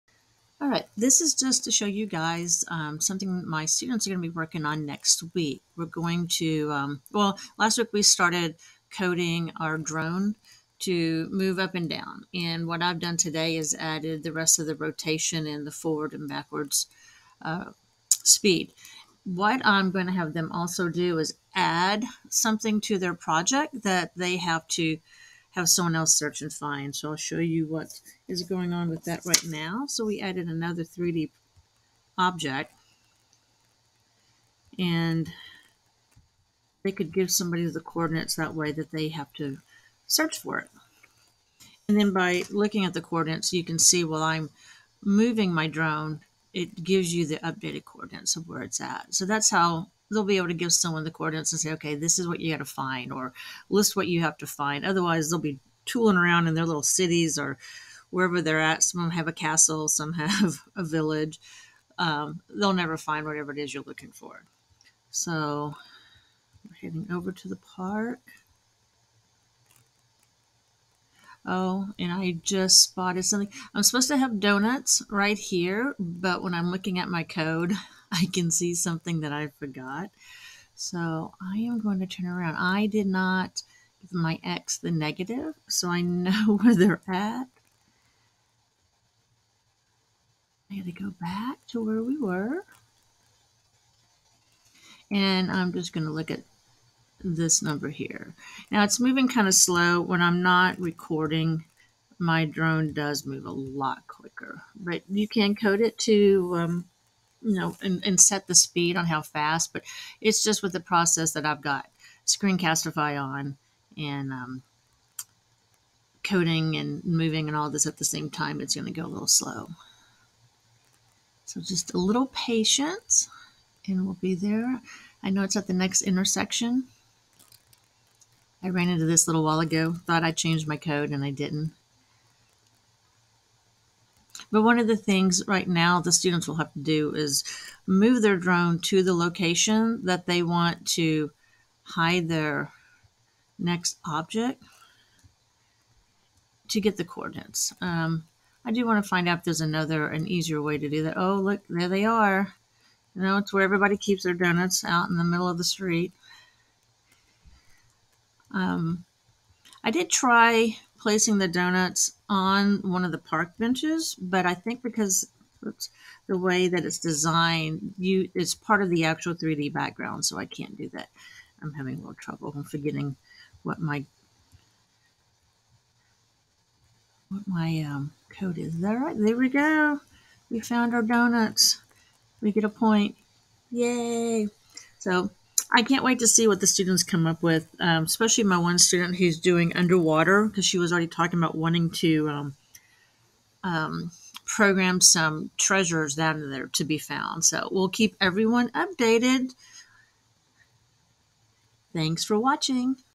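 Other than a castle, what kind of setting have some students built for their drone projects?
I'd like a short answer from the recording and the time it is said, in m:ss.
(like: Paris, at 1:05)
village, at 1:00.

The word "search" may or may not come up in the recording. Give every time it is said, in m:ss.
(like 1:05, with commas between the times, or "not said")
0:26, 0:40.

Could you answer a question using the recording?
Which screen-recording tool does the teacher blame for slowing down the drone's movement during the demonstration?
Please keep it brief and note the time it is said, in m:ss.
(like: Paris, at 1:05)
Screencastify, at 1:52.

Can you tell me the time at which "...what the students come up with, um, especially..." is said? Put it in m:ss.
3:06.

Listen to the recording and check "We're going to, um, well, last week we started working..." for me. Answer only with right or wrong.
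wrong.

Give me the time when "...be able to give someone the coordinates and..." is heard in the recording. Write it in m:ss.
0:50.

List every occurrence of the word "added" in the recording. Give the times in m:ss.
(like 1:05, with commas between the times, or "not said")
0:13, 0:30.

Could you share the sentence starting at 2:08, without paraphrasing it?
I ran into this a little while ago, thought I changed my code and I didn't.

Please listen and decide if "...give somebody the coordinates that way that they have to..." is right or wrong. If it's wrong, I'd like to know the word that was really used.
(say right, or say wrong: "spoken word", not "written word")
right.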